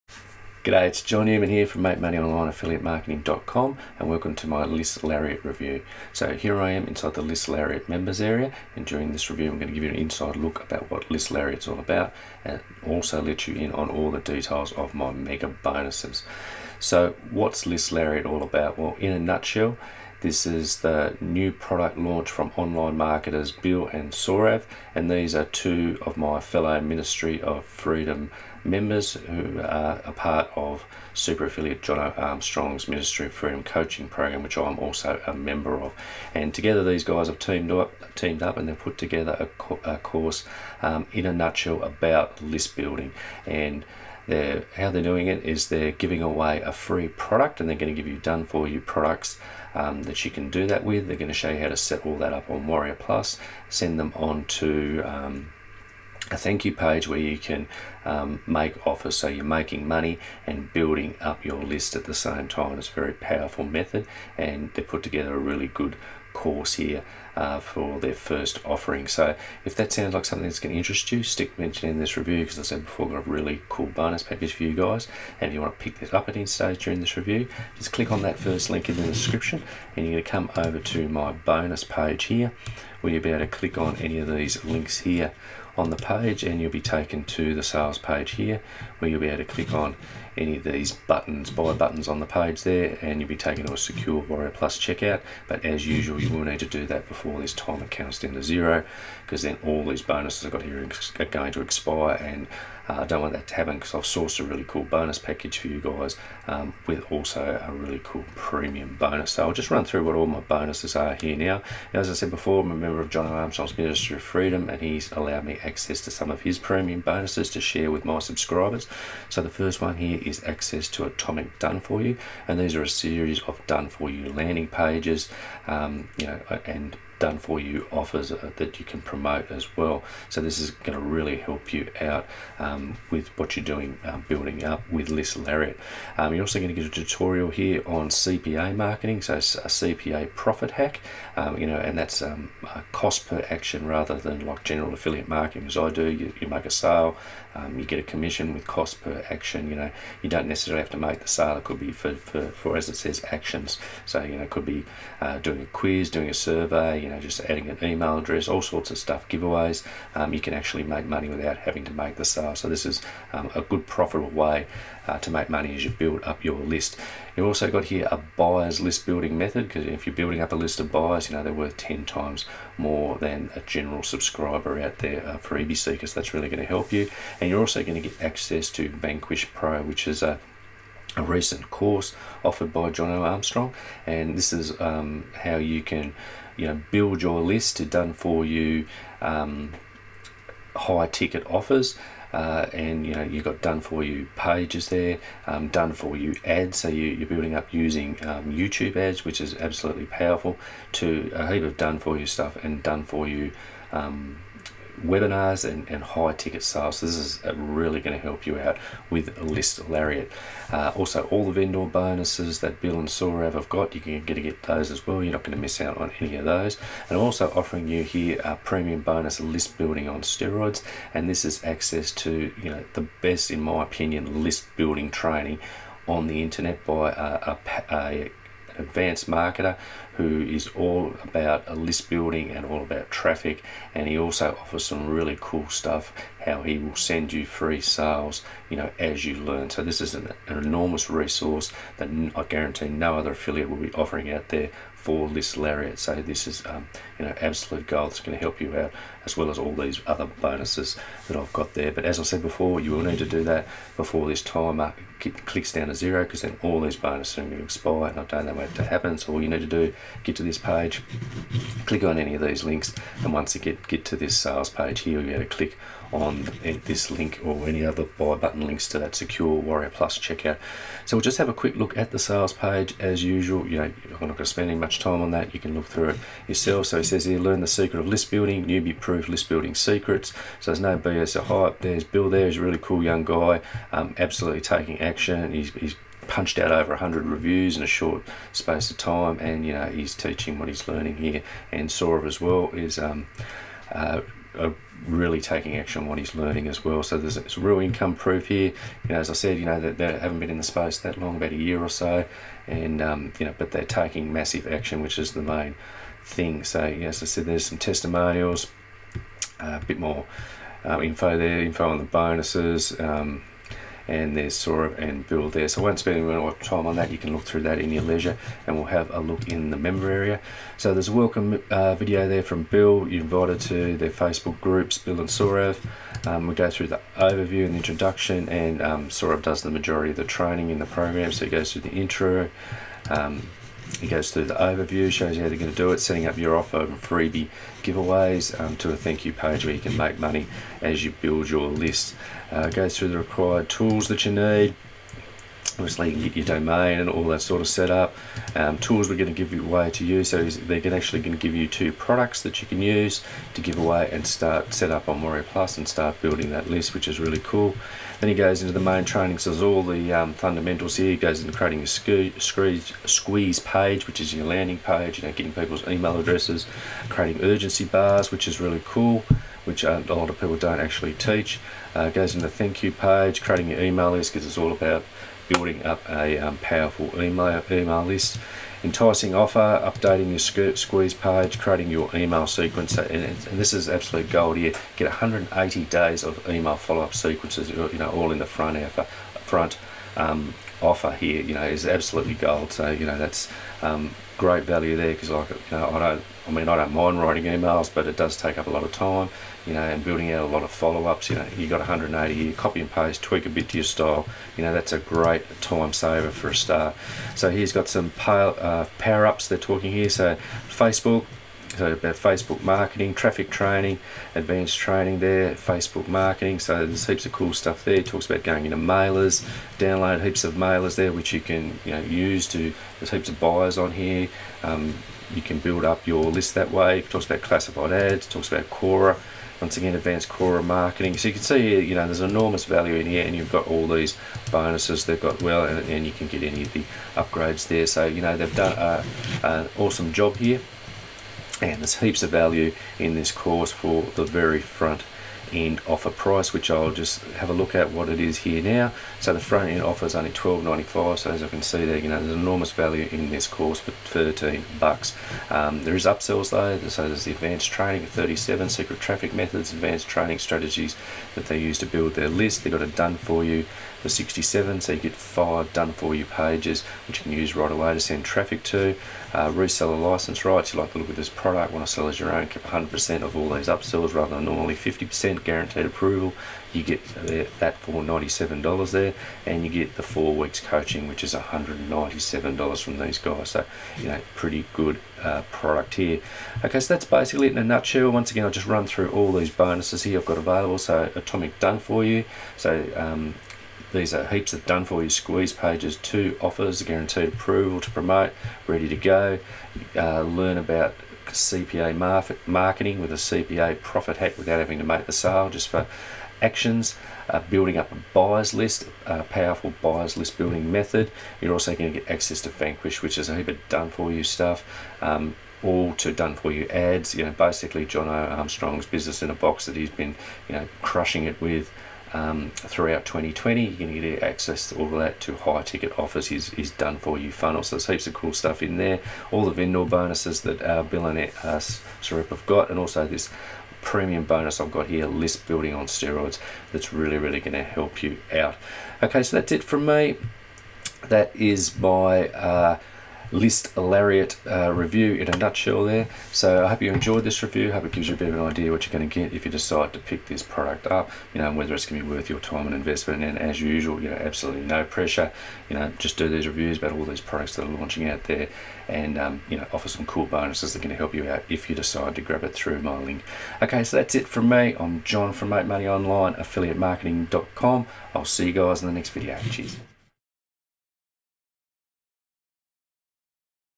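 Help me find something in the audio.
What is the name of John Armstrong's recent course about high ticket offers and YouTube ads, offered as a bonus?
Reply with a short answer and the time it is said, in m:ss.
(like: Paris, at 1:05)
Vanquish Pro, at 2:58.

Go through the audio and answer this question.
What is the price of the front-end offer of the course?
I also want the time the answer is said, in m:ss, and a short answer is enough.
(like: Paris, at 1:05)
$12.95, at 7:30.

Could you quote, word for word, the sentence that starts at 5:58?
Then he goes into the main training, so there's all the um, fundamentals here.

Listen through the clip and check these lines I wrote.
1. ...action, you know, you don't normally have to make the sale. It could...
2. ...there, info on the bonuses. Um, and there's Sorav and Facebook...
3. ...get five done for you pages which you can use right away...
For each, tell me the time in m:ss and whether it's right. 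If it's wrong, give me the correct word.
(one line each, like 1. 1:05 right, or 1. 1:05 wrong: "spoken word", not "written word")
1. 2:29 wrong: "necessarily", not "normally"
2. 5:11 wrong: "Bill", not "Facebook"
3. 7:44 right.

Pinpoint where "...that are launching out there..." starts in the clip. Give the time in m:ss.
9:17.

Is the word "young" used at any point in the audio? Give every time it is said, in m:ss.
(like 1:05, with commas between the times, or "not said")
4:43.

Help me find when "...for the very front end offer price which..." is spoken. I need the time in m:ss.
7:23.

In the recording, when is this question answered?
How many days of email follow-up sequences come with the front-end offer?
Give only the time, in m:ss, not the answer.
6:25.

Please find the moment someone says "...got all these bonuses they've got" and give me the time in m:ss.
7:13.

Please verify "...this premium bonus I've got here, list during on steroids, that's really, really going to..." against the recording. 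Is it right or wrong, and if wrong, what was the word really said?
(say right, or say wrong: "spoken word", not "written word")
wrong: "building", not "during".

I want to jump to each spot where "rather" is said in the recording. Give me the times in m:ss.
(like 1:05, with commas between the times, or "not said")
2:23, 7:54.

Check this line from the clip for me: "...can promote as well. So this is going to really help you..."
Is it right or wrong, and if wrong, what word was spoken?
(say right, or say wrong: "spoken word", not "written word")
right.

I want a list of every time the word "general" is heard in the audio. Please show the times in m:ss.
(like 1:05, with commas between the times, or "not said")
2:24, 2:53.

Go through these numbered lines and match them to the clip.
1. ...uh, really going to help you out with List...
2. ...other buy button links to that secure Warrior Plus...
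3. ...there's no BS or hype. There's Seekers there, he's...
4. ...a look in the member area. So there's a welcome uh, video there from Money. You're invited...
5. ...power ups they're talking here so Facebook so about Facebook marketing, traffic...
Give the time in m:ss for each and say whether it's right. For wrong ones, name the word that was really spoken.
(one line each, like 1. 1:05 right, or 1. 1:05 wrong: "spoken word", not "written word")
1. 3:27 right
2. 4:27 right
3. 4:40 wrong: "Bill", not "Seekers"
4. 5:19 wrong: "Bill", not "Money"
5. 6:48 right.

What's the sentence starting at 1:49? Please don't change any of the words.
So I'll just run through what all my bonuses are here now.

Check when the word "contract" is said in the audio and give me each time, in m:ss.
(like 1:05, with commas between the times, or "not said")
not said.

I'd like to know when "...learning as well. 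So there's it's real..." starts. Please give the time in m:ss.
4:56.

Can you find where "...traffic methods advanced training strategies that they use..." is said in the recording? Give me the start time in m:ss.
7:39.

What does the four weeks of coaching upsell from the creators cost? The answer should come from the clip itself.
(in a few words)
$197.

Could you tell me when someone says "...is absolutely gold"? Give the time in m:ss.
6:31.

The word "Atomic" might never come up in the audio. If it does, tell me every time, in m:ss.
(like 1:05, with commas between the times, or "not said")
2:01, 8:11.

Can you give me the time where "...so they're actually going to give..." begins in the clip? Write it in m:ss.
5:50.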